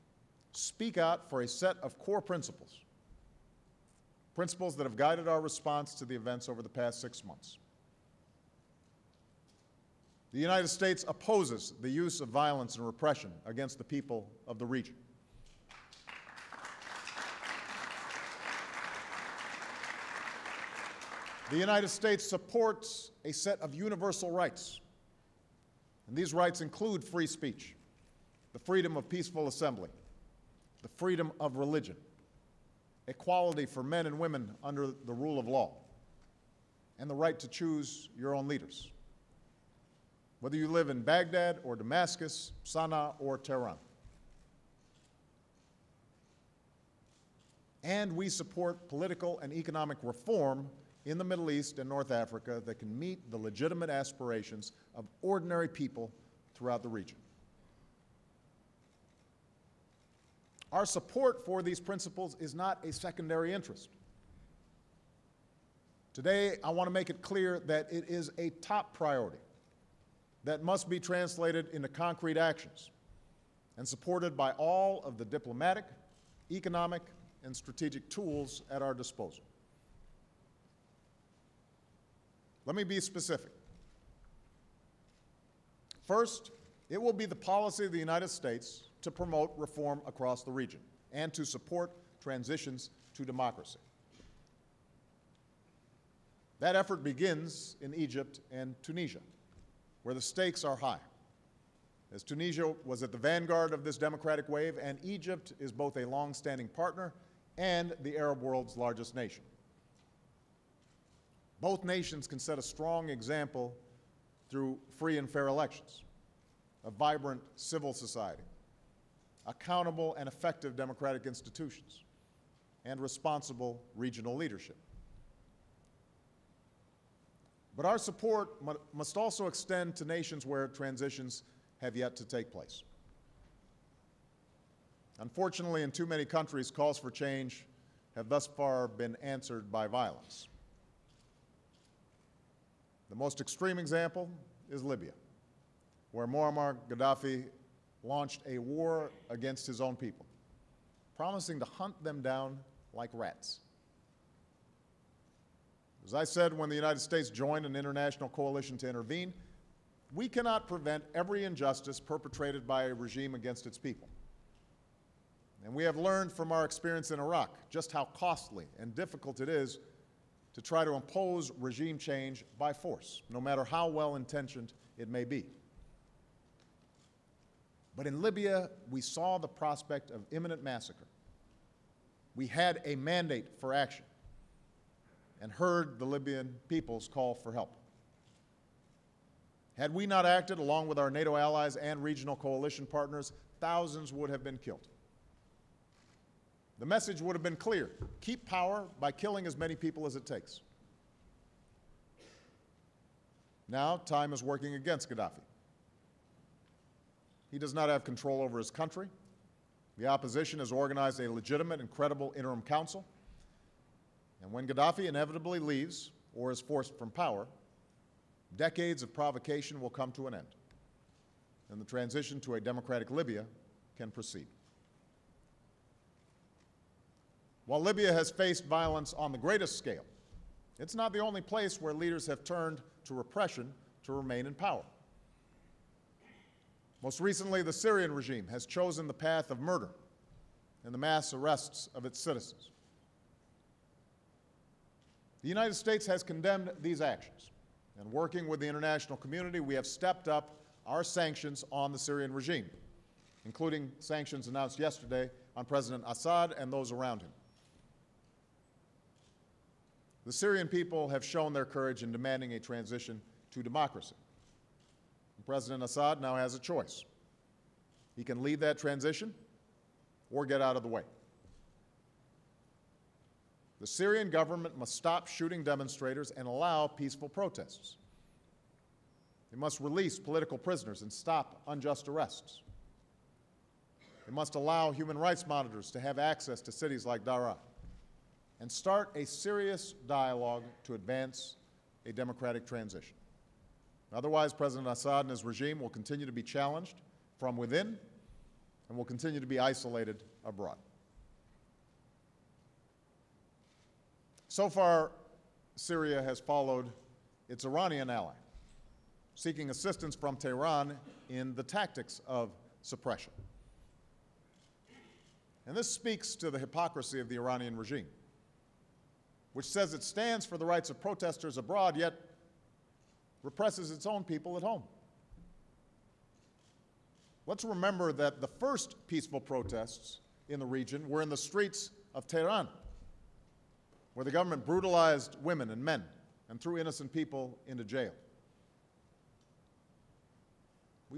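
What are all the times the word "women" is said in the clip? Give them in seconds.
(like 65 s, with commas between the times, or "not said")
34 s, 335 s.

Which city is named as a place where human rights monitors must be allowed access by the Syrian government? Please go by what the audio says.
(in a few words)
Daraa.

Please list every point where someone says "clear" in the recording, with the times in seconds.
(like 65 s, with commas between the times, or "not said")
67 s, 197 s.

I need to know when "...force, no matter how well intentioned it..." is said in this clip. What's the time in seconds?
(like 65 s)
172 s.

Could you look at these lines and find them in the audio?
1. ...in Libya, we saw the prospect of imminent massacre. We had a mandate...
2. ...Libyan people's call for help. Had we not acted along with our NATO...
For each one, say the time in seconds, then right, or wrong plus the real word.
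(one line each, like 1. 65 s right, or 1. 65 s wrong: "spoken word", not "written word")
1. 178 s right
2. 186 s right.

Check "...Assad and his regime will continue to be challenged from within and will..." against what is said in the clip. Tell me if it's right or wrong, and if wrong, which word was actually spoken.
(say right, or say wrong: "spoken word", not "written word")
right.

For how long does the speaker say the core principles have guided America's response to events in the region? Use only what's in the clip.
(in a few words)
6 months.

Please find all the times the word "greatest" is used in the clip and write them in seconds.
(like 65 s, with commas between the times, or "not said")
229 s.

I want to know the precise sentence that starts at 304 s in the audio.
So far, Syria has followed its Iranian ally, seeking assistance from Tehran in the tactics of suppression.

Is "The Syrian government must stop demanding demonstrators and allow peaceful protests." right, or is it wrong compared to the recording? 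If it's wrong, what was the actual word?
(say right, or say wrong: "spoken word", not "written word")
wrong: "shooting", not "demanding".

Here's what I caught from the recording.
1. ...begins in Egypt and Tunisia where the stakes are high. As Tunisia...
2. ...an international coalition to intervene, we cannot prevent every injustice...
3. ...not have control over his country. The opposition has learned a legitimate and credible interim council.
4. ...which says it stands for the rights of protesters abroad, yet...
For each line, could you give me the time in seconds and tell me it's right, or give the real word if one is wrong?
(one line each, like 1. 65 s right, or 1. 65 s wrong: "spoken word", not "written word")
1. 97 s right
2. 157 s right
3. 207 s wrong: "organized", not "learned"
4. 319 s right.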